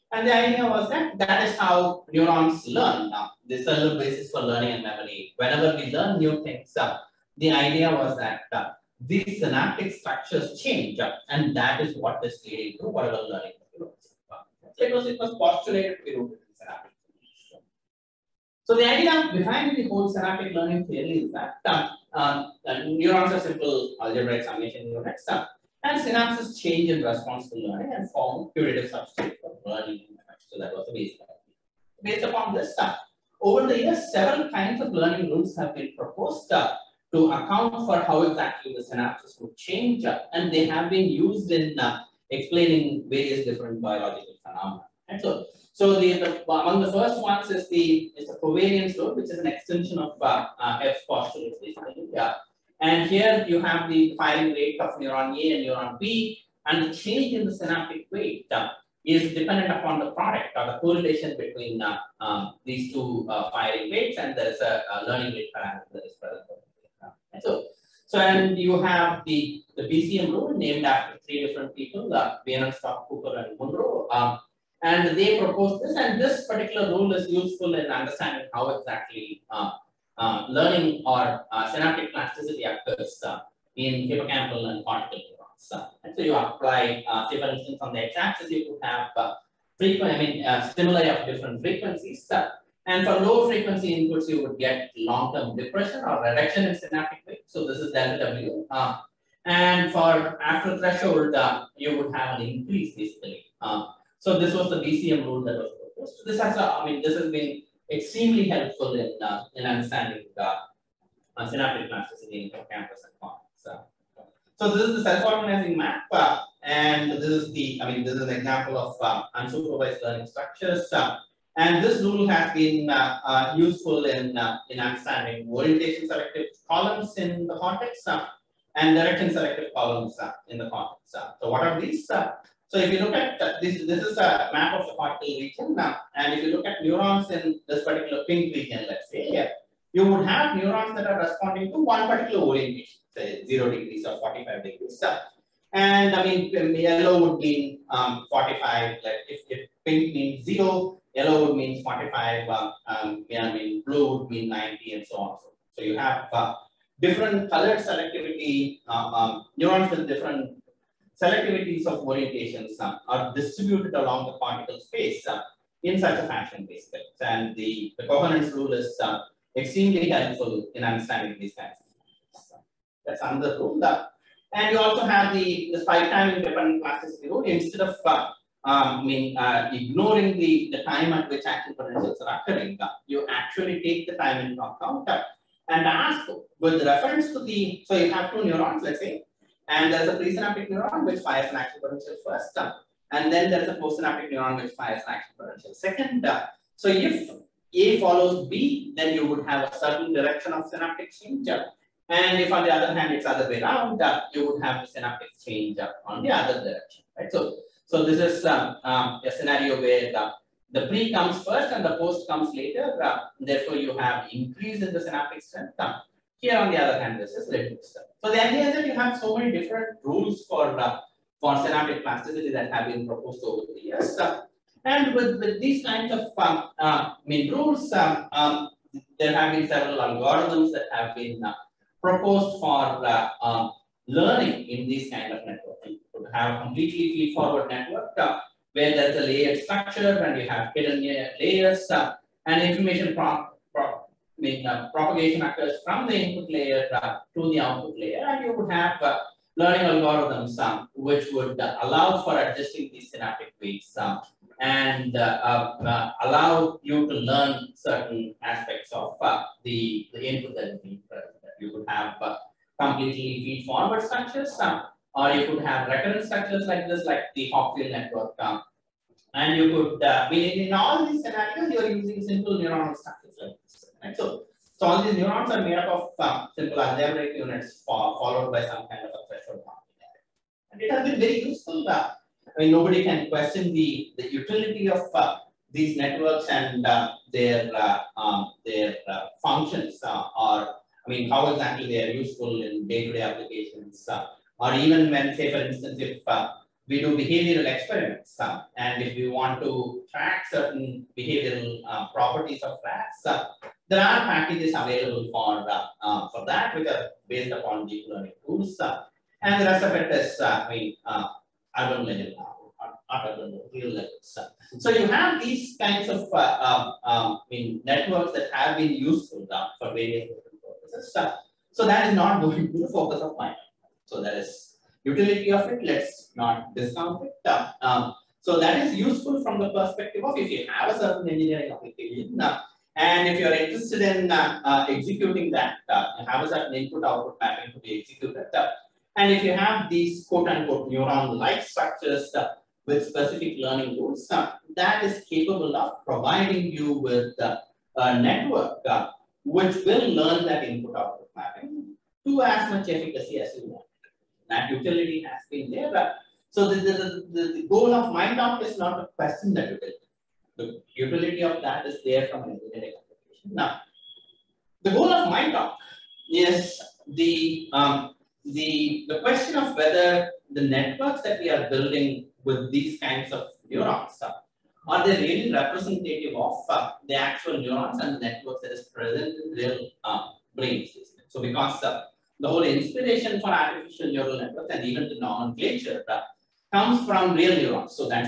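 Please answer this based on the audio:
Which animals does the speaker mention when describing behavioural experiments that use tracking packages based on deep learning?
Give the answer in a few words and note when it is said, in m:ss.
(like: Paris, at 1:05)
rats, at 5:02.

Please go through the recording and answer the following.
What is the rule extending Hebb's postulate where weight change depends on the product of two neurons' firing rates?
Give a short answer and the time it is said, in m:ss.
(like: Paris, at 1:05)
covariance law, at 0:48.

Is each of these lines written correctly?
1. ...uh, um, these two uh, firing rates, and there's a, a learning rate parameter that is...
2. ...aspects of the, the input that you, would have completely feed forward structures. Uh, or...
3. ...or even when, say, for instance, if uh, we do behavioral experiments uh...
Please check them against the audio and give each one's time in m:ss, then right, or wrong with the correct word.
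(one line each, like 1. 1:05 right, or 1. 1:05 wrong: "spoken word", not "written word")
1. 1:01 right
2. 4:18 right
3. 4:54 right.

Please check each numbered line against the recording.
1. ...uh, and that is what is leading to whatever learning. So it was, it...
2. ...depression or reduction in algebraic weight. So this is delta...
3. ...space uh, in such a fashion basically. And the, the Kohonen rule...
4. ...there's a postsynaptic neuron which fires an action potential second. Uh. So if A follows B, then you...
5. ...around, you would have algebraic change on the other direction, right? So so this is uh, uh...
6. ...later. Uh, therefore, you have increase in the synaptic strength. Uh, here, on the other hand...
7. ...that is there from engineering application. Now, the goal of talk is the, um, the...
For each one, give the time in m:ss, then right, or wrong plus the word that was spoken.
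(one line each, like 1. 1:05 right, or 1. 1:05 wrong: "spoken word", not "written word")
1. 0:10 right
2. 1:35 wrong: "synaptic", not "algebraic"
3. 2:44 right
4. 3:13 right
5. 3:23 wrong: "synaptic", not "algebraic"
6. 3:32 right
7. 6:01 right.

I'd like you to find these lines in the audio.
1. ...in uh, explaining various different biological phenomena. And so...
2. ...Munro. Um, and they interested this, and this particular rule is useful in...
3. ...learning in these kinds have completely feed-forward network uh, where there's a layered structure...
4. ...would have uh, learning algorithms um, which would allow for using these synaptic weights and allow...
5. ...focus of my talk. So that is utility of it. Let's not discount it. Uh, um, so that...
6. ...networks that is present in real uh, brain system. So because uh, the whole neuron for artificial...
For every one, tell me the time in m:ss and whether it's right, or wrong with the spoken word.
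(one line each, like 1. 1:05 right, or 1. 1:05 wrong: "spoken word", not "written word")
1. 0:41 right
2. 1:13 wrong: "proposed", not "interested"
3. 3:54 right
4. 4:08 wrong: "adjusting", not "using"
5. 5:22 right
6. 6:18 wrong: "inspiration", not "neuron".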